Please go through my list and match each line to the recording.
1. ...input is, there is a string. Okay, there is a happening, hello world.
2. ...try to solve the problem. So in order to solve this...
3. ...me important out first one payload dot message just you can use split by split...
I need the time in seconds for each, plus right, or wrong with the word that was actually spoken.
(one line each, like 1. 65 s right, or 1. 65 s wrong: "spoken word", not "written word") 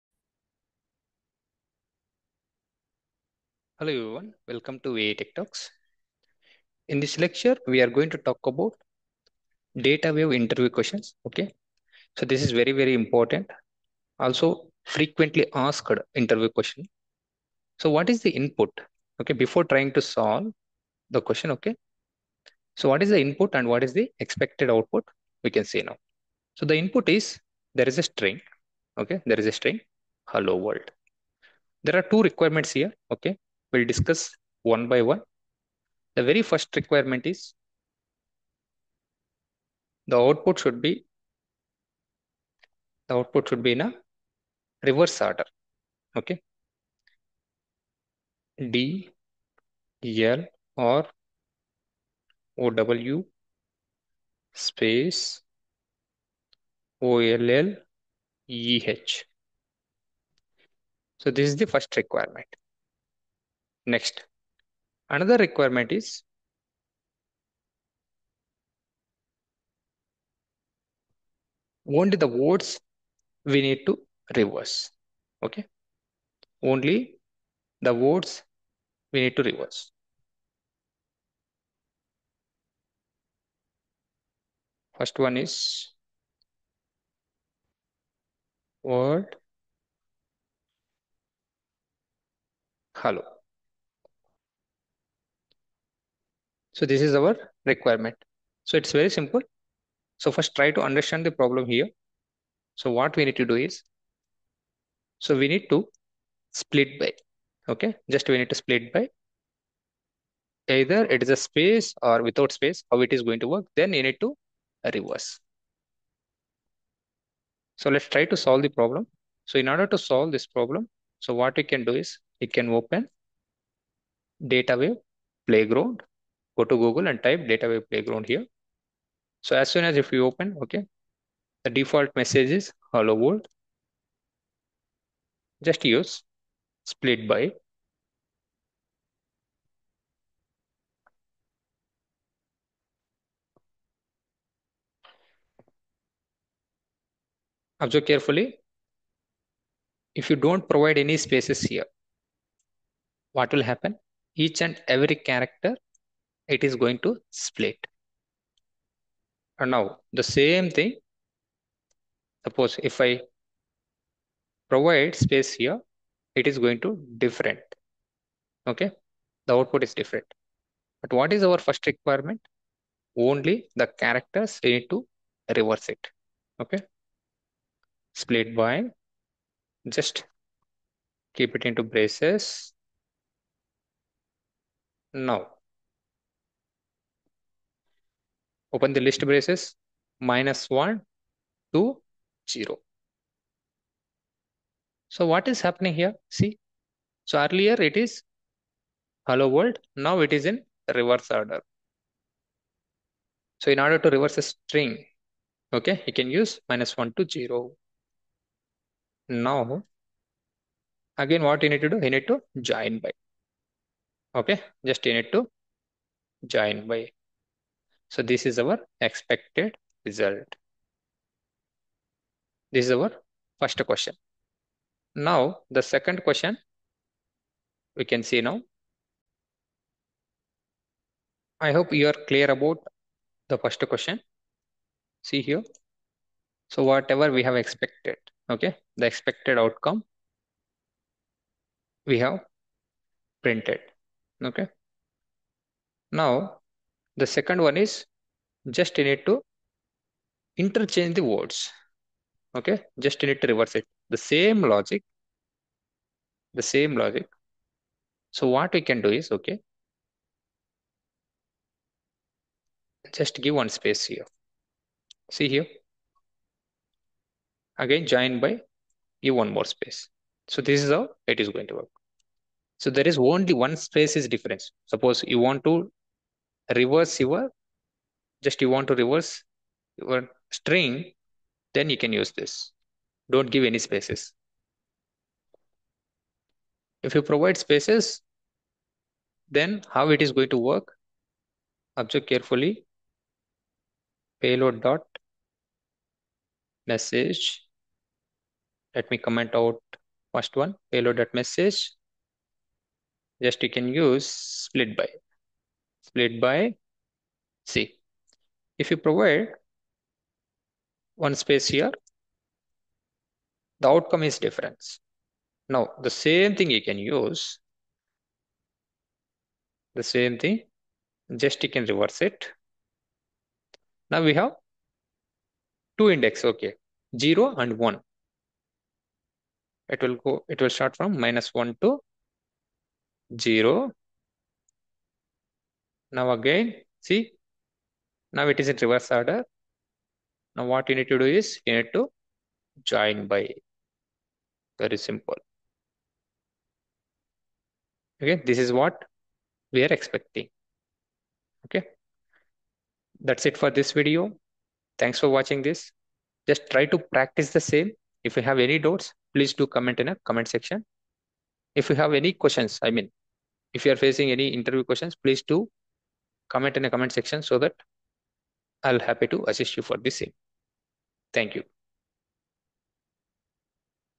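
1. 26 s wrong: "string", not "happening"
2. 118 s right
3. 299 s wrong: "comment", not "important".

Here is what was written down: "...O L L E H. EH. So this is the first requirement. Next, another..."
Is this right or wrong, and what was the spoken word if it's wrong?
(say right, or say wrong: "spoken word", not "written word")
right.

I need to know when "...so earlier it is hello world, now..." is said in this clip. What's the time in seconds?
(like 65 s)
197 s.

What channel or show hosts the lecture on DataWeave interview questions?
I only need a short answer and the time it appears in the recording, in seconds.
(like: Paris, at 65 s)
ViTech Talks, at 4 s.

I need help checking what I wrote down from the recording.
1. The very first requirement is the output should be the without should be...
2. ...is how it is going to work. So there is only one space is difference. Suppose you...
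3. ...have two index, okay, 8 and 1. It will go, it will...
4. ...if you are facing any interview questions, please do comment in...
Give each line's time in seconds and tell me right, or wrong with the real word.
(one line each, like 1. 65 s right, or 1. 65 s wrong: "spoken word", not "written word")
1. 36 s wrong: "output", not "without"
2. 270 s right
3. 324 s wrong: "0", not "8"
4. 363 s right.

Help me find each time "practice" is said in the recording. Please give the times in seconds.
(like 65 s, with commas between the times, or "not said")
356 s.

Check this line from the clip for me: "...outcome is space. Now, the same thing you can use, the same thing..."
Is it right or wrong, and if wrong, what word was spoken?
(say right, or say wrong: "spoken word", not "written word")
wrong: "difference", not "space".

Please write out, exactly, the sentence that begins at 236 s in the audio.
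So whatever we have expected, okay, the expected outcome we have printed, okay.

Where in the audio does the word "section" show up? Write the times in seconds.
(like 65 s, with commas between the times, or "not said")
360 s, 367 s.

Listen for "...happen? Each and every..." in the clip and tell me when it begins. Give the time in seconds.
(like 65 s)
153 s.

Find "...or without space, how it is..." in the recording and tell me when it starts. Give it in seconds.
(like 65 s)
112 s.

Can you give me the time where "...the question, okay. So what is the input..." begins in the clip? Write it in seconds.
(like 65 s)
21 s.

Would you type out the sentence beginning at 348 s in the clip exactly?
Okay, this is what we are expecting.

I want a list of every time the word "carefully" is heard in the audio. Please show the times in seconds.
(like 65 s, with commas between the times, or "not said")
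148 s, 292 s.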